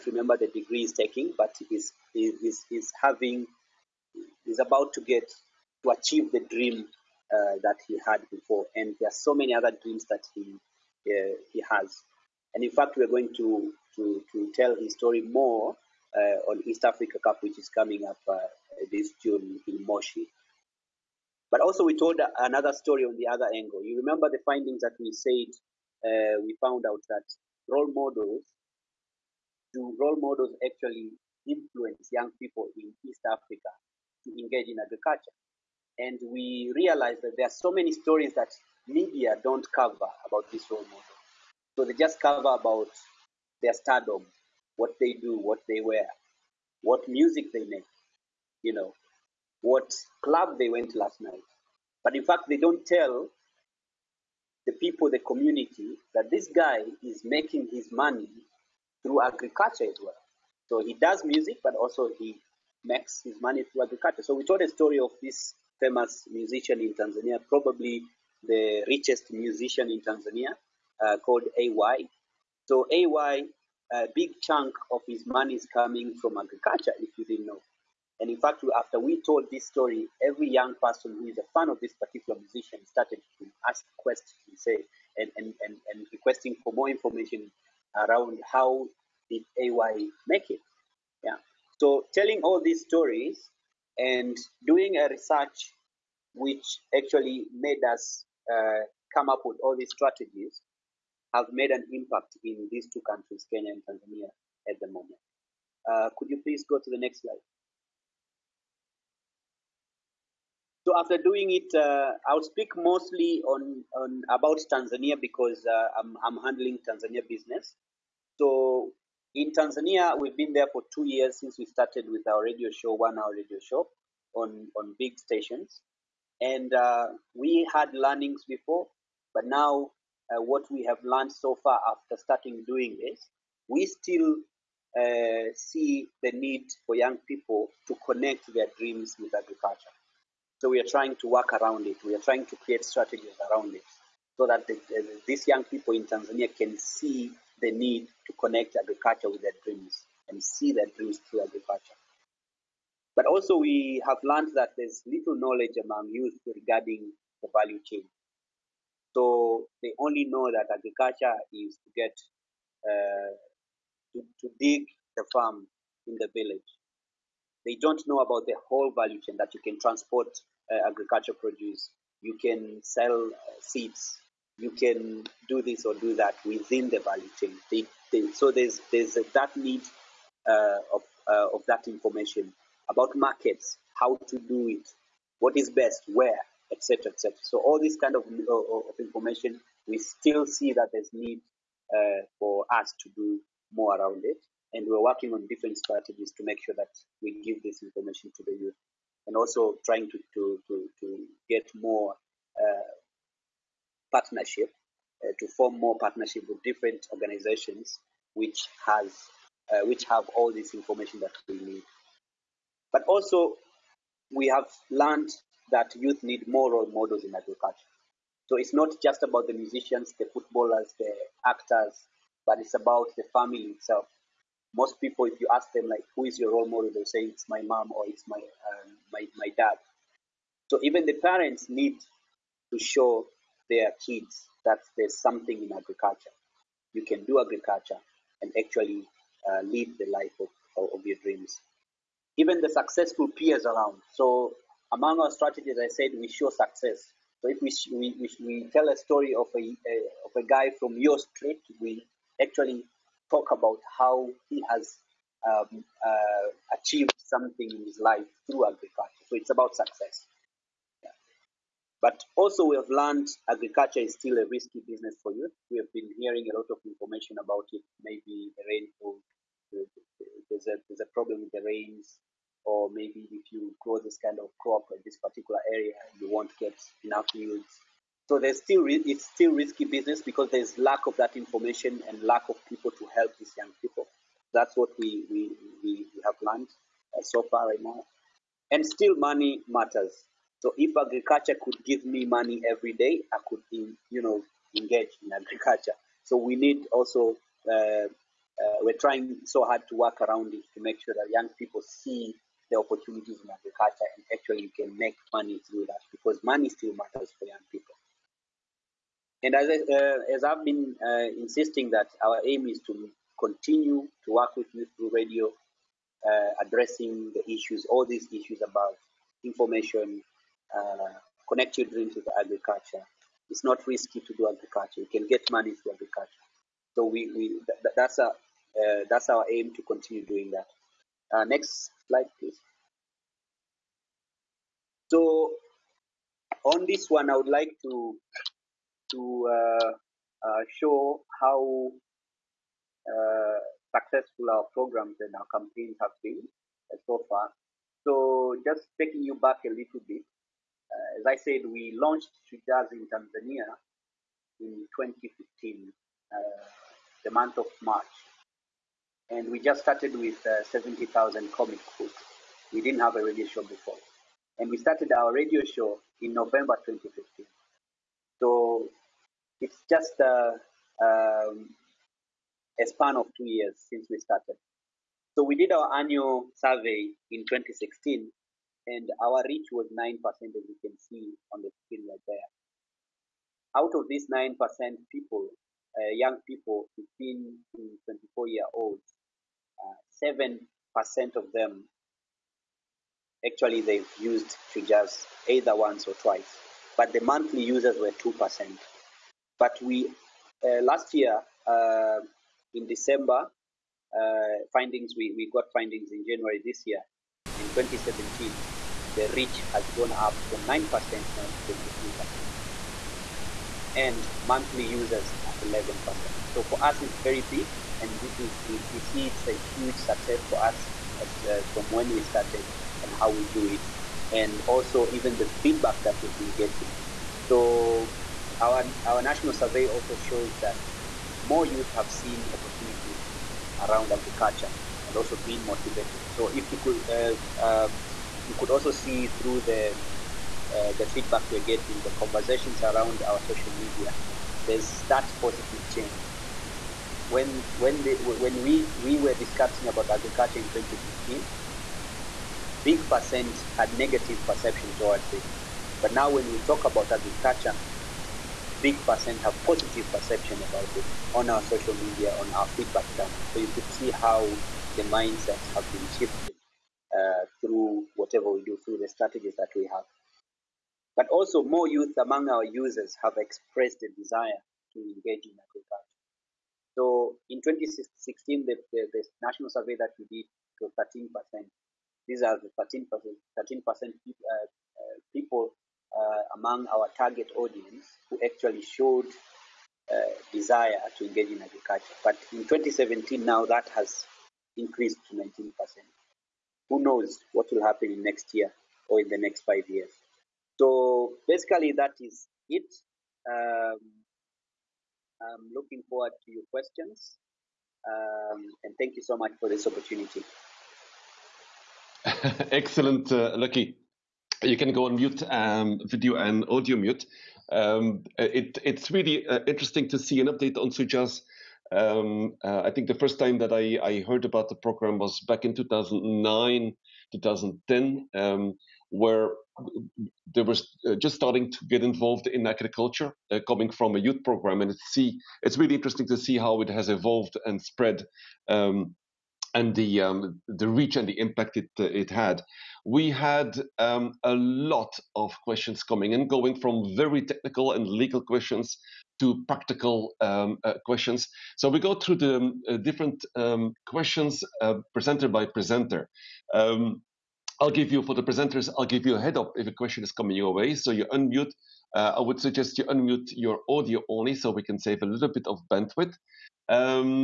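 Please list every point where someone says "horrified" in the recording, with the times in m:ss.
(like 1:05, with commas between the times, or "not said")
not said.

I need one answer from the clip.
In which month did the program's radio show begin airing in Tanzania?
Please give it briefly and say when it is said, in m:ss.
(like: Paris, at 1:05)
November, at 6:06.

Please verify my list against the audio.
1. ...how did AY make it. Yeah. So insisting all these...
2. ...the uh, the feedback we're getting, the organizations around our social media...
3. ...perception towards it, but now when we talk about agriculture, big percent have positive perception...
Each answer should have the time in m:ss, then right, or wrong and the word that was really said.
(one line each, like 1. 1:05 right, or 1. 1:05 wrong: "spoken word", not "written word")
1. 1:28 wrong: "telling", not "insisting"
2. 7:19 wrong: "conversations", not "organizations"
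3. 7:34 right.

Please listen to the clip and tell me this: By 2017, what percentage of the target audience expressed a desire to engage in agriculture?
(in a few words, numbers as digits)
19%.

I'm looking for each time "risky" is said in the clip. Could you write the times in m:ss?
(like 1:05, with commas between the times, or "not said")
4:24, 4:39, 5:23.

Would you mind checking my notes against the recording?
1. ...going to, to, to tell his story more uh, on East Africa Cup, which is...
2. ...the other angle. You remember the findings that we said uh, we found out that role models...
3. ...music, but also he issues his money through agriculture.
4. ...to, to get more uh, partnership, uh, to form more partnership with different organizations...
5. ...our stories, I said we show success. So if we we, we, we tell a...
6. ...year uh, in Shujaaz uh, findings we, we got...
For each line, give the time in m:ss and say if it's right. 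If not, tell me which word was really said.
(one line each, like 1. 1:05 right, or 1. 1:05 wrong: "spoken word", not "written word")
1. 0:13 right
2. 0:23 right
3. 1:01 wrong: "makes", not "issues"
4. 3:20 right
5. 4:05 wrong: "strategies", not "stories"
6. 6:41 wrong: "December", not "Shujaaz".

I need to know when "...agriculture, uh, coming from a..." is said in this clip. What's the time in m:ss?
8:52.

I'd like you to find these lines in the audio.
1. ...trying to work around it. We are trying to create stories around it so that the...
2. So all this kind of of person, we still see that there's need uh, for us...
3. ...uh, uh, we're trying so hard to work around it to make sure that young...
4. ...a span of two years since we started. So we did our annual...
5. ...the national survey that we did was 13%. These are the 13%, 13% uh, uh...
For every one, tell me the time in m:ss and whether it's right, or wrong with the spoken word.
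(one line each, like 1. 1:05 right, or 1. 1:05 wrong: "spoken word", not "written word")
1. 2:20 wrong: "strategies", not "stories"
2. 3:07 wrong: "information", not "person"
3. 4:57 right
4. 6:12 right
5. 7:59 right.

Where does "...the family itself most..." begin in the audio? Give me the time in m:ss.
3:43.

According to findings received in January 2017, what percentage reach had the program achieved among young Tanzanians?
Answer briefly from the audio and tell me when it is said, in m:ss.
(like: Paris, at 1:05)
23%, at 6:51.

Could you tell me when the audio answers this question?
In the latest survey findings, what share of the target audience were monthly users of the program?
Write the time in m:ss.
6:55.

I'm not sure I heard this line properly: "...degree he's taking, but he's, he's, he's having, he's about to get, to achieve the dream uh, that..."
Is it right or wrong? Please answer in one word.
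right.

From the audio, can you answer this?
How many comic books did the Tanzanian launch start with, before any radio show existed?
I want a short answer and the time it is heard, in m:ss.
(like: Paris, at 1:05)
70,000, at 6:00.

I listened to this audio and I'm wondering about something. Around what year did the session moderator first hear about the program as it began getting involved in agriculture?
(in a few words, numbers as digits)
2009.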